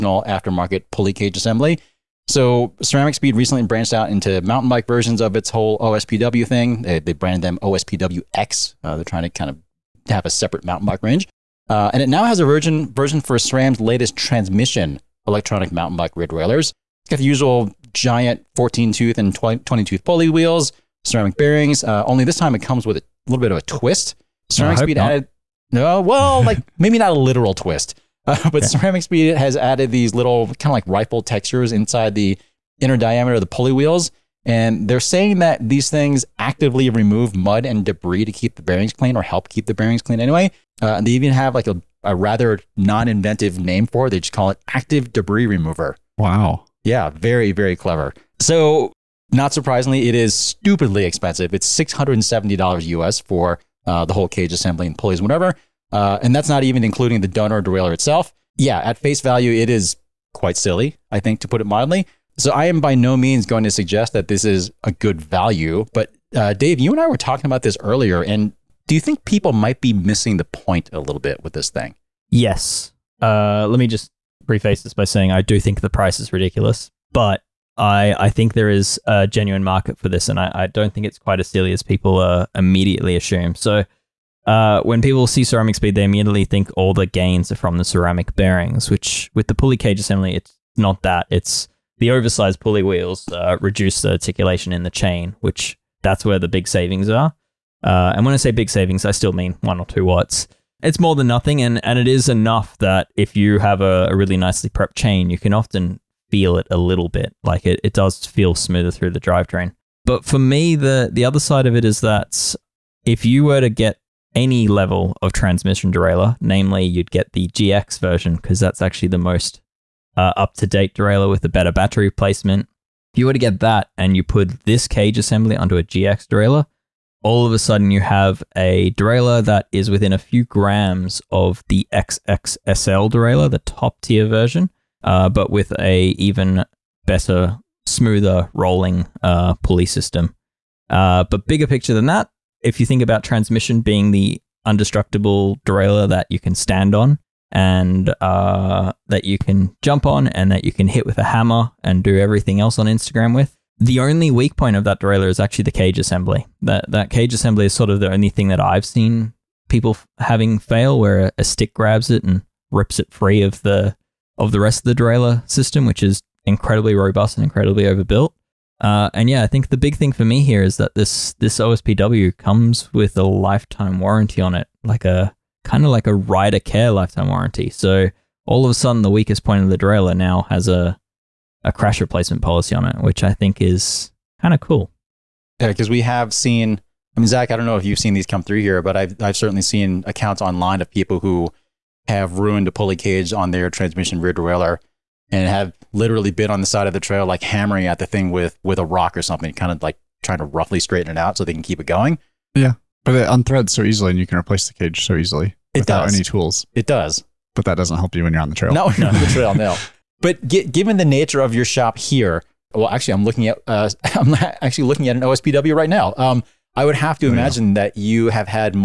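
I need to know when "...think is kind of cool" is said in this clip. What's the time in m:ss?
3:03.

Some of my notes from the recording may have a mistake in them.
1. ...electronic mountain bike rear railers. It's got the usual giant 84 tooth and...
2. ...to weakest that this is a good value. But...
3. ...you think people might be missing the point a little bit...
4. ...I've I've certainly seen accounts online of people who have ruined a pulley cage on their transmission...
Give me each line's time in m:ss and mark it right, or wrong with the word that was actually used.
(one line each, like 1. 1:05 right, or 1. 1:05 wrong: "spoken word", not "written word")
1. 0:15 wrong: "14", not "84"
2. 1:03 wrong: "suggest", not "weakest"
3. 1:08 right
4. 3:08 right.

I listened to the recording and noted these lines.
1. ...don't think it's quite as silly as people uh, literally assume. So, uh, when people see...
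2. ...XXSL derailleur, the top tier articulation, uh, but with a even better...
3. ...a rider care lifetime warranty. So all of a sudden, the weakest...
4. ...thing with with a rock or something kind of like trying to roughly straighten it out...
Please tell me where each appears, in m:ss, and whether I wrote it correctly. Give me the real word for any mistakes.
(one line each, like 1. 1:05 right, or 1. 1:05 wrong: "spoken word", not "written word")
1. 1:20 wrong: "immediately", not "literally"
2. 2:11 wrong: "version", not "articulation"
3. 2:56 right
4. 3:18 right.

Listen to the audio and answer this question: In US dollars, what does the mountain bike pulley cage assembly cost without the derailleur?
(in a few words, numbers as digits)
$670.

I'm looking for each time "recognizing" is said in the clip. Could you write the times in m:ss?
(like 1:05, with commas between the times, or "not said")
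not said.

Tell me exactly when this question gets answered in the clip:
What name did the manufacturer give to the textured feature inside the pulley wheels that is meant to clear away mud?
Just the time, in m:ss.
0:44.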